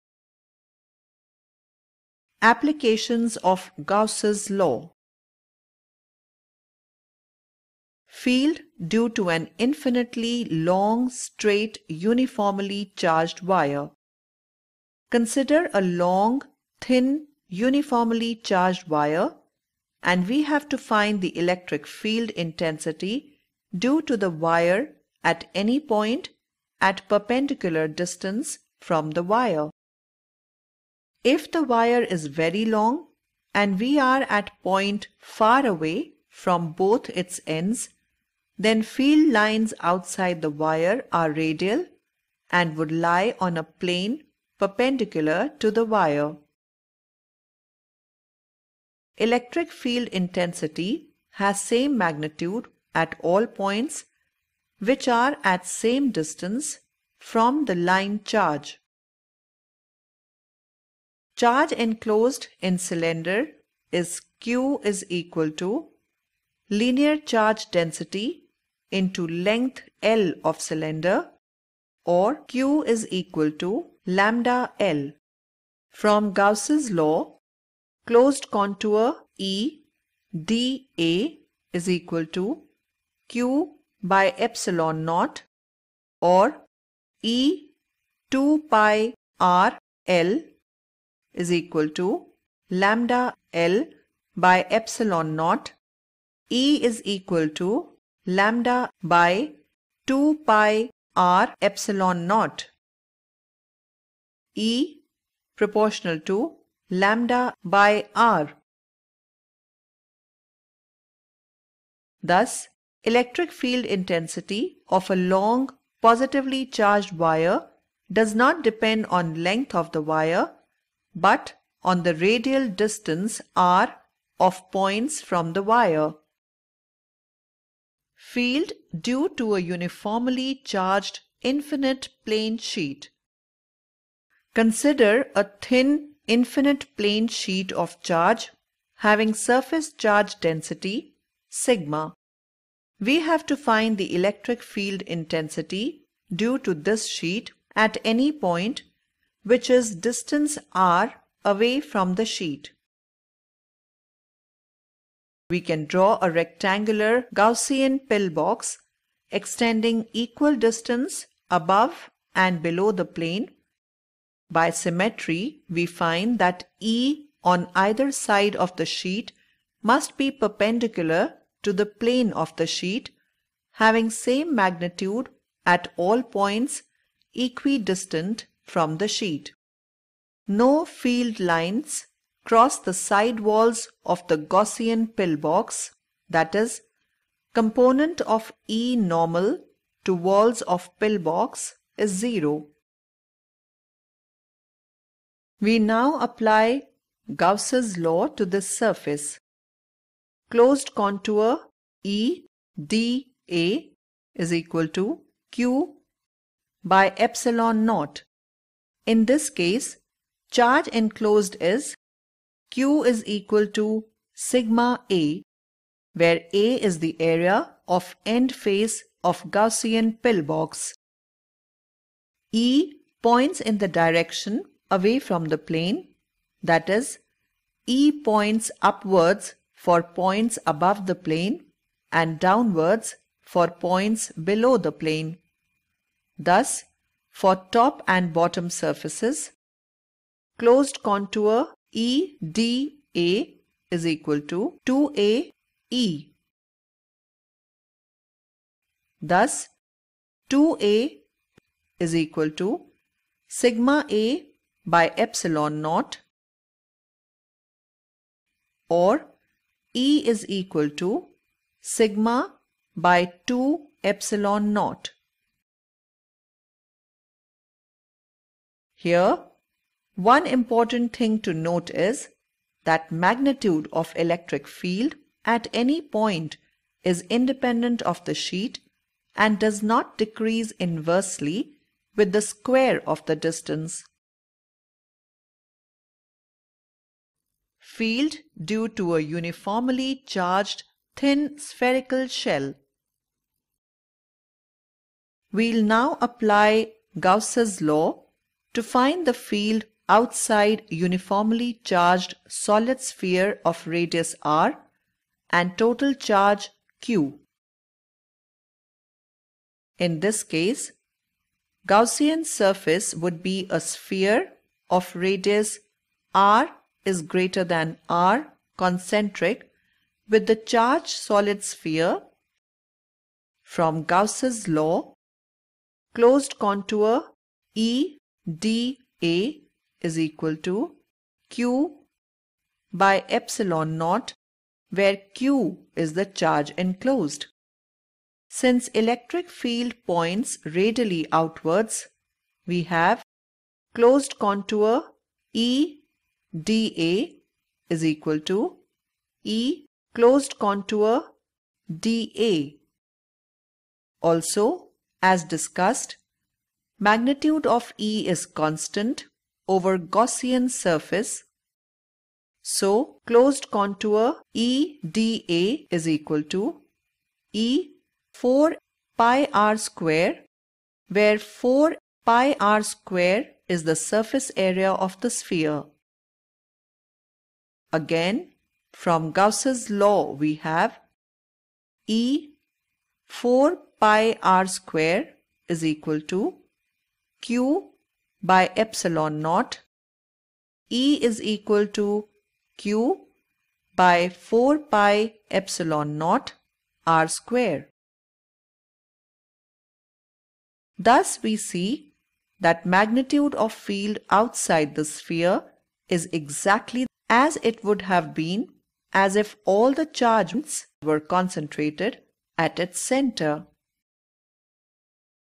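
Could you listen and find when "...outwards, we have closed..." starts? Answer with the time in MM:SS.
05:41.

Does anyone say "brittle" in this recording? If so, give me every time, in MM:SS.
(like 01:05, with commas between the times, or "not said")
not said.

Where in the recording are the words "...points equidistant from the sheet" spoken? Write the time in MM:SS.
02:56.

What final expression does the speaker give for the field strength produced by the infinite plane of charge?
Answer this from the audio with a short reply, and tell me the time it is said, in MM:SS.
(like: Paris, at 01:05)
sigma by 2 epsilon naught, at 04:21.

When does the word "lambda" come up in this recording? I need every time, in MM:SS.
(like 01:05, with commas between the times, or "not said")
01:14, 01:32, 01:38, 01:46.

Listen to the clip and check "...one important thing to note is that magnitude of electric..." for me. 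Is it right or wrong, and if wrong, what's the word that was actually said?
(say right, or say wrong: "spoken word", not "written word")
right.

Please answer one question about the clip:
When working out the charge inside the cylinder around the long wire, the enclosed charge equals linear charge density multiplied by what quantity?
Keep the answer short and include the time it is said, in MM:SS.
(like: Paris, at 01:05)
length L of cylinder, at 01:09.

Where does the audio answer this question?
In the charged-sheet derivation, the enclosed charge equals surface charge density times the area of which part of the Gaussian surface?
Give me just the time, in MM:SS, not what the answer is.
03:38.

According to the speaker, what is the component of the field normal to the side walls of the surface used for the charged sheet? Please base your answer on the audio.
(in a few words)
0.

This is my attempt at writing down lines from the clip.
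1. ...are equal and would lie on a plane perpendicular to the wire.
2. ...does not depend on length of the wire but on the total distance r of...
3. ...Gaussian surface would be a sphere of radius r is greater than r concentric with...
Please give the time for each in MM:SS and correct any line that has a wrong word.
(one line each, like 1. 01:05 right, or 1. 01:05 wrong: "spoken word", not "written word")
1. 00:41 wrong: "radial", not "equal"
2. 01:58 wrong: "radial", not "total"
3. 05:11 right.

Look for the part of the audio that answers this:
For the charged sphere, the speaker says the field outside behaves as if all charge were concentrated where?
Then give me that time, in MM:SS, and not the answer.
06:52.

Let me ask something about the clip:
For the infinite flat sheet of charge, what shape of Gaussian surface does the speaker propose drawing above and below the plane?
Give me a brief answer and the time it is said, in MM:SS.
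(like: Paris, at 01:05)
rectangular Gaussian pillbox, at 02:36.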